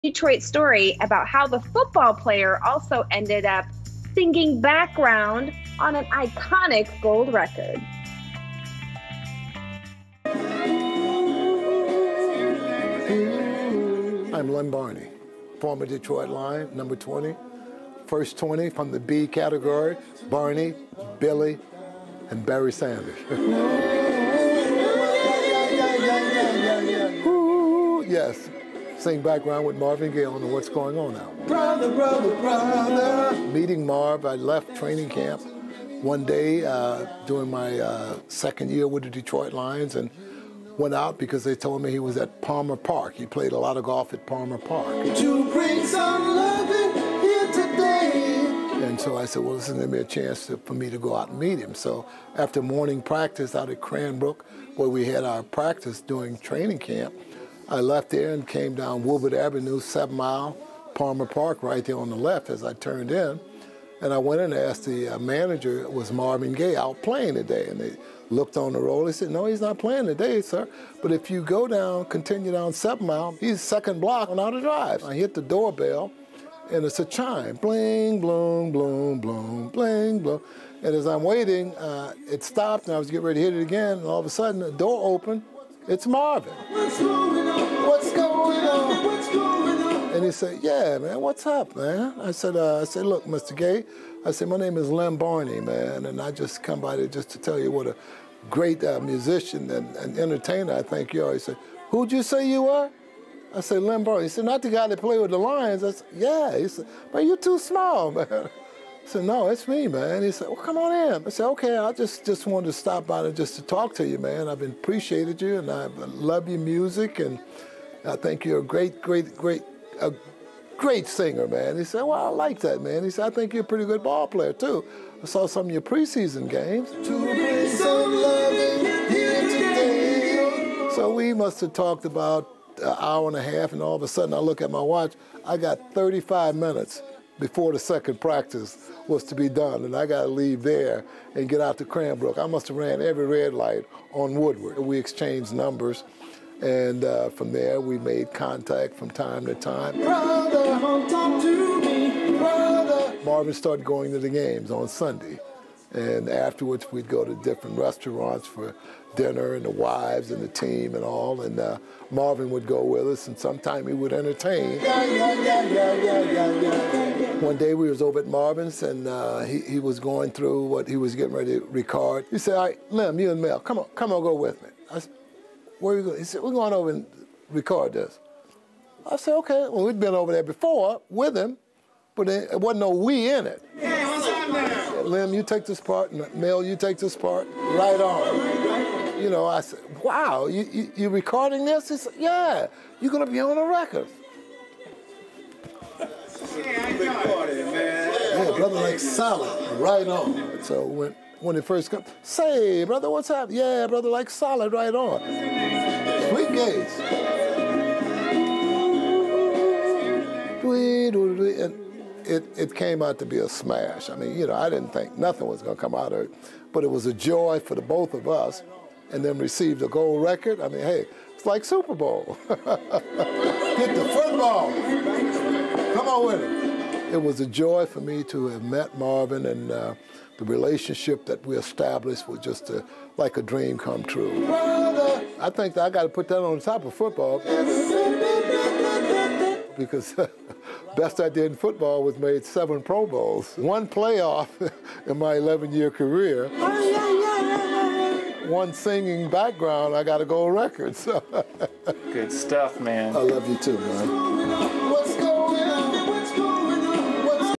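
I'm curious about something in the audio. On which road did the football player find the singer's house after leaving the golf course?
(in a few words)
Outer Drive.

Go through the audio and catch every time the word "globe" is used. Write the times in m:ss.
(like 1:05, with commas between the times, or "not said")
not said.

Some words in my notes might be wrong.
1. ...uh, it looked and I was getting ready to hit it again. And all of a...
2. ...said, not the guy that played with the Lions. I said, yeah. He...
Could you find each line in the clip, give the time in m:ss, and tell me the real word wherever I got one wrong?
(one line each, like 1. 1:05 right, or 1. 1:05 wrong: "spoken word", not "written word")
1. 1:21 wrong: "stopped", not "looked"
2. 1:44 right.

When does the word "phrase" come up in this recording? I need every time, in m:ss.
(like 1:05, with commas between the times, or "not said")
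not said.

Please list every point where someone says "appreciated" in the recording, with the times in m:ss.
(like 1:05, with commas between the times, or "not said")
1:54.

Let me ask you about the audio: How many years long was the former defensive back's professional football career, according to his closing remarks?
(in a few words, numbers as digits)
11.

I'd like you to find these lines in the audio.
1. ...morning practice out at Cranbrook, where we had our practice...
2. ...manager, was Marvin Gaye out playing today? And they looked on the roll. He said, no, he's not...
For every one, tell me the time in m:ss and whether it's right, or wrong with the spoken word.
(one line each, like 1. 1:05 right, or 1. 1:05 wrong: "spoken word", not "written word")
1. 0:52 right
2. 1:05 right.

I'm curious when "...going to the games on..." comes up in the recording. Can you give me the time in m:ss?
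2:33.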